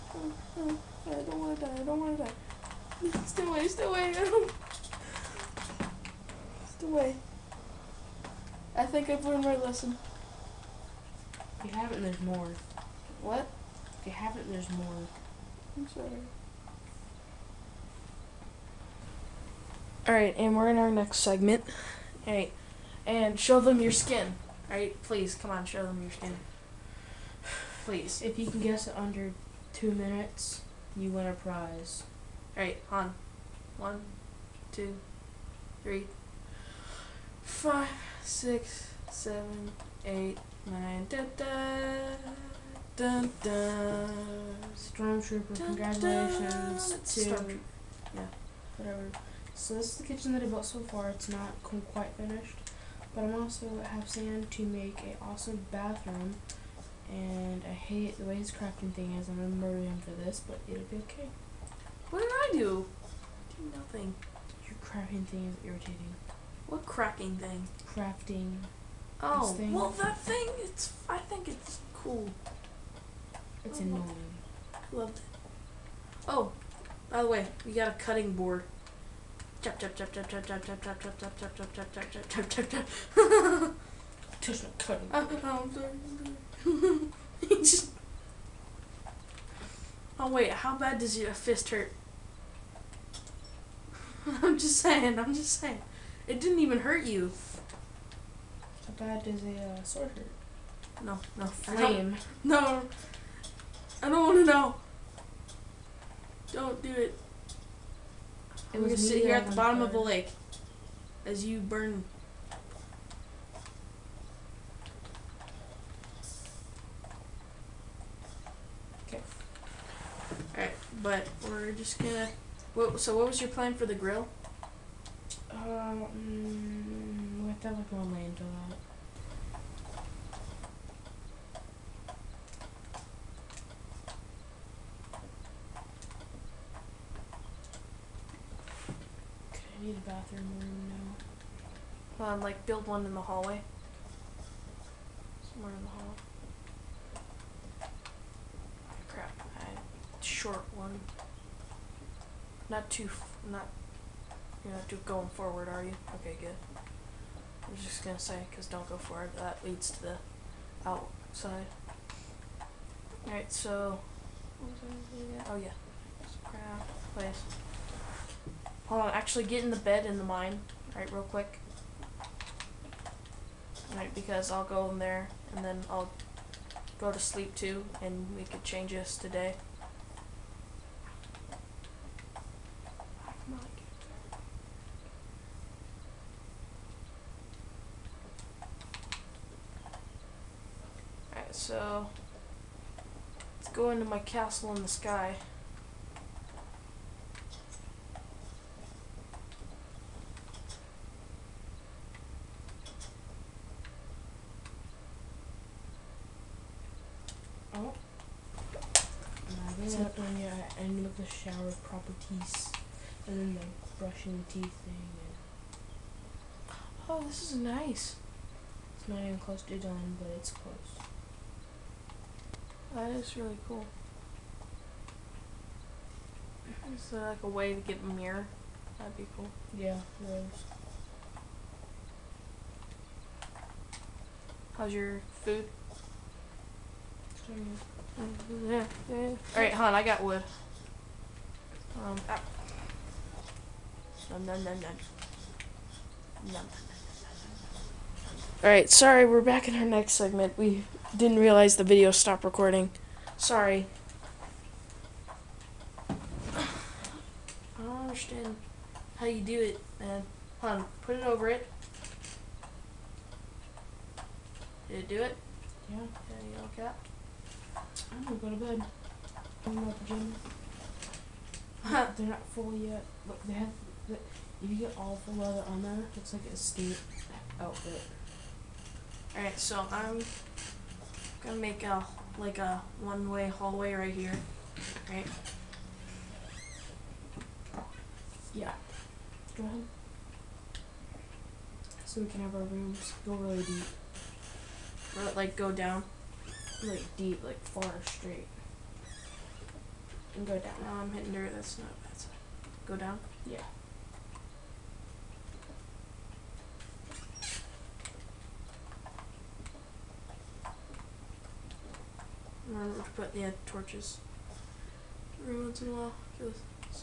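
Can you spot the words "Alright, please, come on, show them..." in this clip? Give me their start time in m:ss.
0:24.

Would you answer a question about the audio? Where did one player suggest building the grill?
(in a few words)
in the hallway.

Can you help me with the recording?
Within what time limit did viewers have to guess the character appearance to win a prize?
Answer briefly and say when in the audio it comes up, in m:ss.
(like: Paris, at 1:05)
2 minutes, at 0:29.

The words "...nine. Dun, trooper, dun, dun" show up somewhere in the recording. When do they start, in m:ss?
0:40.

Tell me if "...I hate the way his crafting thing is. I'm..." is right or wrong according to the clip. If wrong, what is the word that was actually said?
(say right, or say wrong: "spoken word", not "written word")
right.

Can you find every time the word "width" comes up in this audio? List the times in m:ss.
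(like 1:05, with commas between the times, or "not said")
not said.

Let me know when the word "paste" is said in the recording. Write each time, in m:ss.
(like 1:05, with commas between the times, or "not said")
not said.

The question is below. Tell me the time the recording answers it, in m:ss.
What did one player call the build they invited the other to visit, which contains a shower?
3:14.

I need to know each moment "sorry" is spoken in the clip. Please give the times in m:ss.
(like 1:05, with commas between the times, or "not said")
0:15, 1:25, 4:08, 4:13.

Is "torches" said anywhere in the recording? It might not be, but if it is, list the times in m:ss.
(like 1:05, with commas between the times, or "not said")
5:13.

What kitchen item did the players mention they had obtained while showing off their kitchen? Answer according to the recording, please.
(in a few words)
cutting board.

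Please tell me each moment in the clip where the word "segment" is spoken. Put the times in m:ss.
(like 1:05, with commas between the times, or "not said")
0:21, 4:10.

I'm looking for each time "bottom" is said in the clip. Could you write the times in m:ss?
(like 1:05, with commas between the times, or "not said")
1:49.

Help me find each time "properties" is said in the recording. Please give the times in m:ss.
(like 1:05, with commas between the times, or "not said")
3:31.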